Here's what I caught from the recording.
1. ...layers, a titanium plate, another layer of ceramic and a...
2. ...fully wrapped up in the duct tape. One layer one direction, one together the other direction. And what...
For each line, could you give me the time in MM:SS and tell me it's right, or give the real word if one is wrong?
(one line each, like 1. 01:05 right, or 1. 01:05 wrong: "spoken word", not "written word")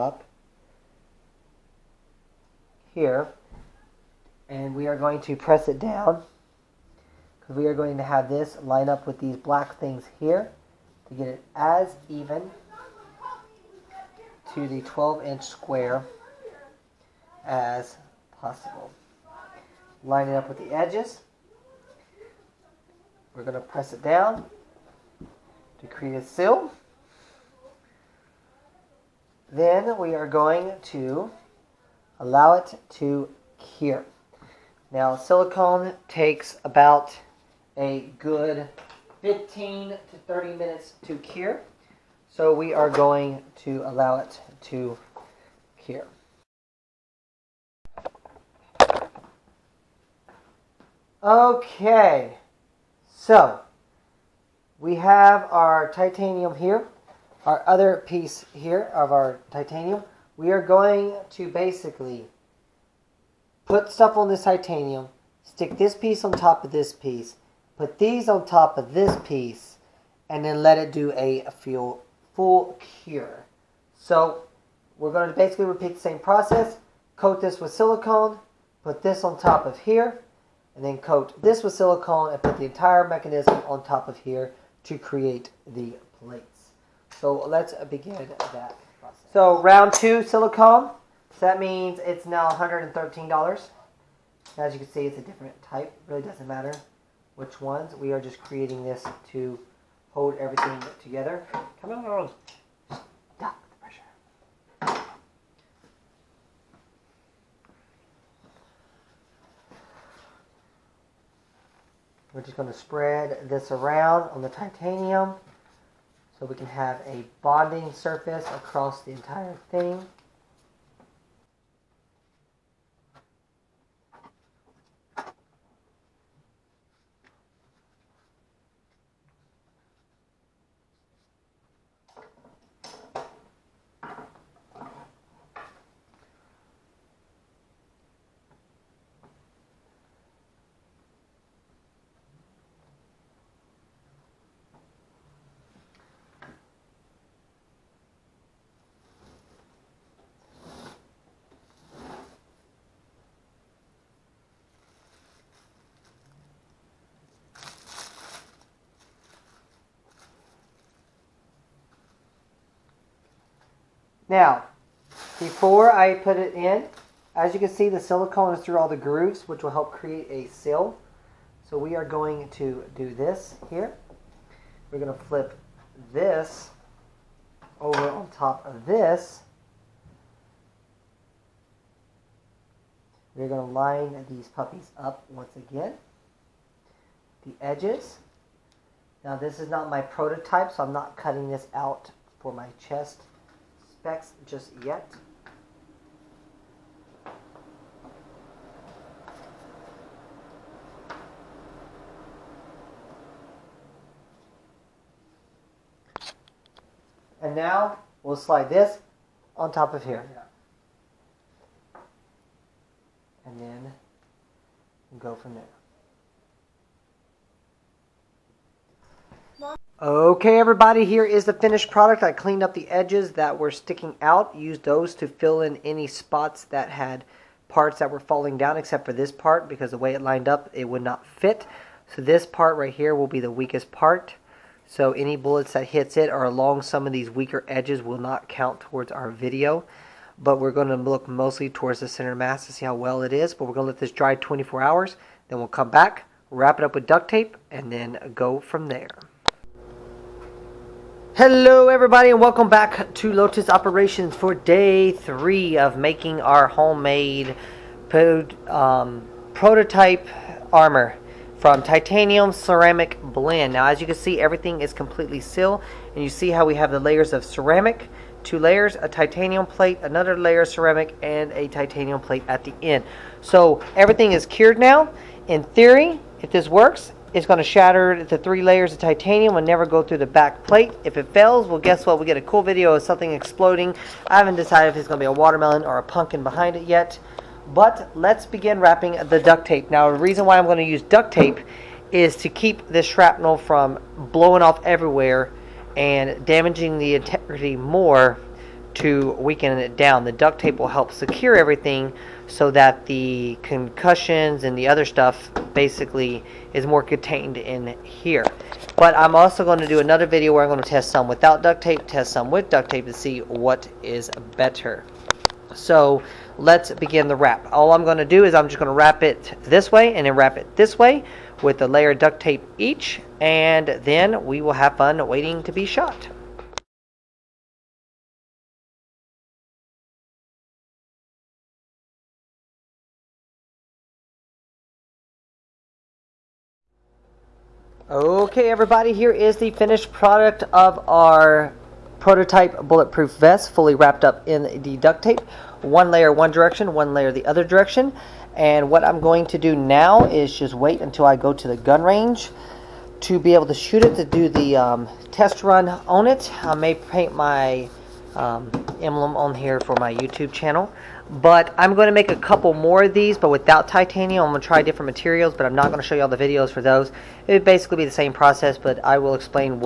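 1. 04:28 right
2. 05:43 wrong: "layer", not "together".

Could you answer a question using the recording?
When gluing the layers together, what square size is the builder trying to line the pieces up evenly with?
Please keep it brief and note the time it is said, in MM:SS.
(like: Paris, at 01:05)
12 inch, at 00:14.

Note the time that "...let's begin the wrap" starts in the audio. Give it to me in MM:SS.
05:16.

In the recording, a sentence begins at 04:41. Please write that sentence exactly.
If it fails, well, guess what?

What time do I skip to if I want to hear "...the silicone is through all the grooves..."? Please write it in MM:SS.
02:47.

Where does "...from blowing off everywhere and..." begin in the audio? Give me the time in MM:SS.
04:53.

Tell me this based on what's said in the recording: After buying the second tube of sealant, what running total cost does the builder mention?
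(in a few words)
$113.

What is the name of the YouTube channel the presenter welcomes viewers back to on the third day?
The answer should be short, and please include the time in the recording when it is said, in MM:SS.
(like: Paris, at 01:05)
Lotus Operations, at 04:13.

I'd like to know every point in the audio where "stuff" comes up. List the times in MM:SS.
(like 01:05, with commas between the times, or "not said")
01:03, 05:05.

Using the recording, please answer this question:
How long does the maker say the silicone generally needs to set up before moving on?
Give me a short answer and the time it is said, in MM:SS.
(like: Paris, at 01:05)
15 to 30 minutes, at 00:39.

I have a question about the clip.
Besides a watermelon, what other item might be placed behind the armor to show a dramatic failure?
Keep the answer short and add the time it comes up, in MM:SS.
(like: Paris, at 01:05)
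pumpkin, at 04:46.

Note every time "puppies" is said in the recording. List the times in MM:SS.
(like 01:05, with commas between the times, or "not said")
03:04.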